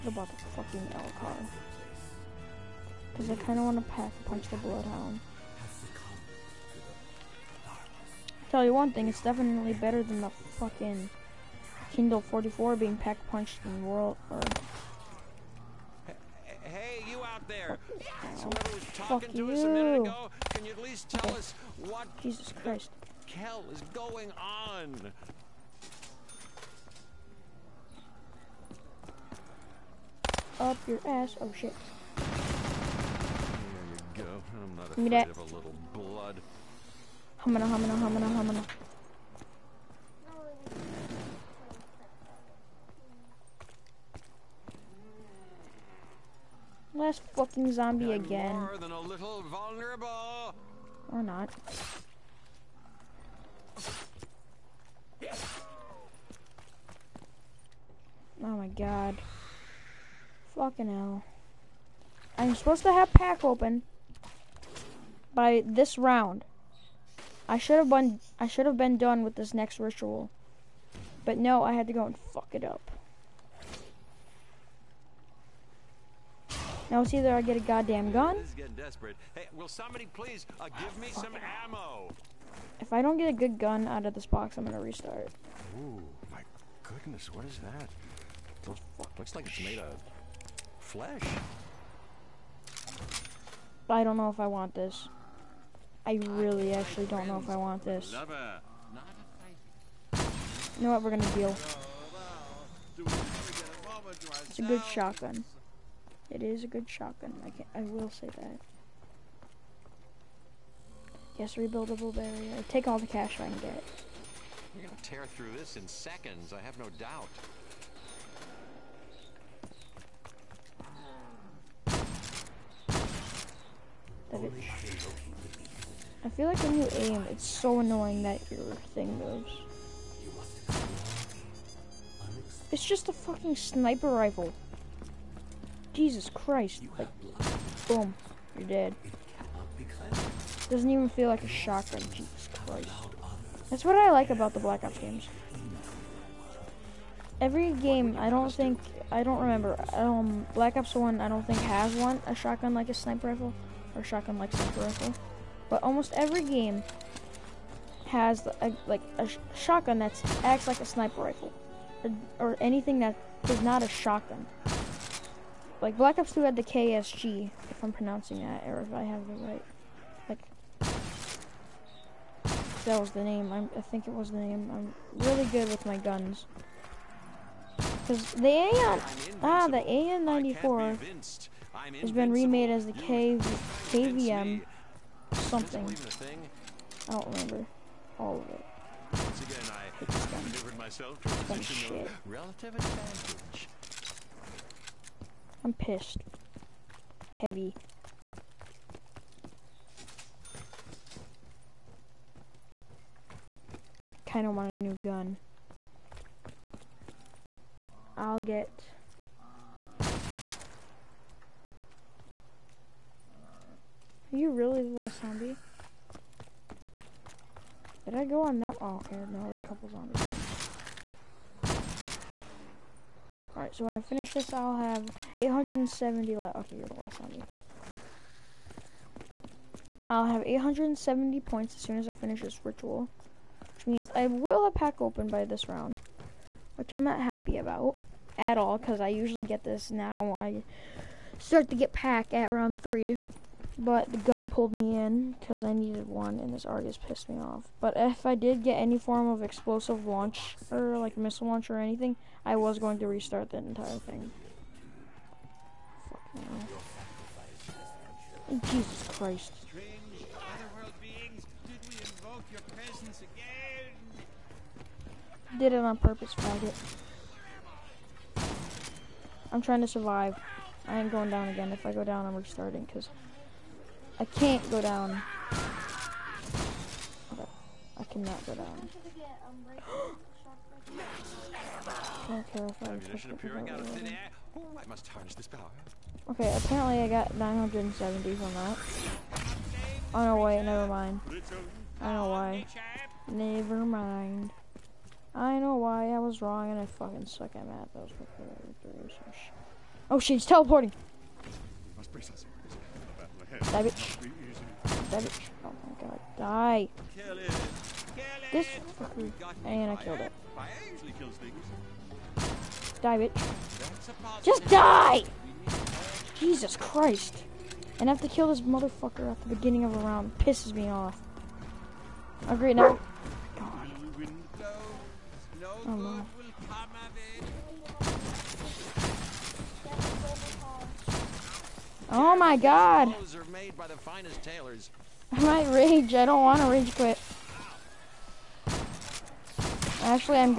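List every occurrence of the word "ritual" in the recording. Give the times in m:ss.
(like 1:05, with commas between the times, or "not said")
1:09, 3:52.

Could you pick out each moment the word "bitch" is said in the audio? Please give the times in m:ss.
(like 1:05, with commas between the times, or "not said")
5:03, 5:13.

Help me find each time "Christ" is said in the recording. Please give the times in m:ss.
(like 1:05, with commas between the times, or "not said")
0:22, 2:16, 2:22, 4:19, 5:16.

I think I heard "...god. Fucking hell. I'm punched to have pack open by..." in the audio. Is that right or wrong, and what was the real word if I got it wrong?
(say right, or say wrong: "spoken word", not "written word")
wrong: "supposed", not "punched".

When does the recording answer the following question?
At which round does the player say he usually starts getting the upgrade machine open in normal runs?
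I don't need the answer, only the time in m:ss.
4:02.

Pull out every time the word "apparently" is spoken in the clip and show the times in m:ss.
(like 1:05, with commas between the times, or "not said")
4:46.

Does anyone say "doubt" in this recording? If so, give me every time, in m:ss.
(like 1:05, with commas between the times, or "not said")
1:56.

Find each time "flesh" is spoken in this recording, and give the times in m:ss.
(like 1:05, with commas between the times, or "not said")
1:30.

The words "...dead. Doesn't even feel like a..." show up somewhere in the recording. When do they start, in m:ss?
2:18.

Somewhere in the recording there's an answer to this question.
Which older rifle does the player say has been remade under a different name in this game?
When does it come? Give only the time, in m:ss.
2:59.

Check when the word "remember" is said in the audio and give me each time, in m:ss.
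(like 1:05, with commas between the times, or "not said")
2:29, 3:07.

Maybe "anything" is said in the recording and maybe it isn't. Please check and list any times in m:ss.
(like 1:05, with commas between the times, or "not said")
2:42, 4:11.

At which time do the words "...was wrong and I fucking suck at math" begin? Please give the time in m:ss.
4:56.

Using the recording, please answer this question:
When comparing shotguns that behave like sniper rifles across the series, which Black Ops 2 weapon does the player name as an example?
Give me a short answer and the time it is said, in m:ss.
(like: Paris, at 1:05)
KSG, at 2:46.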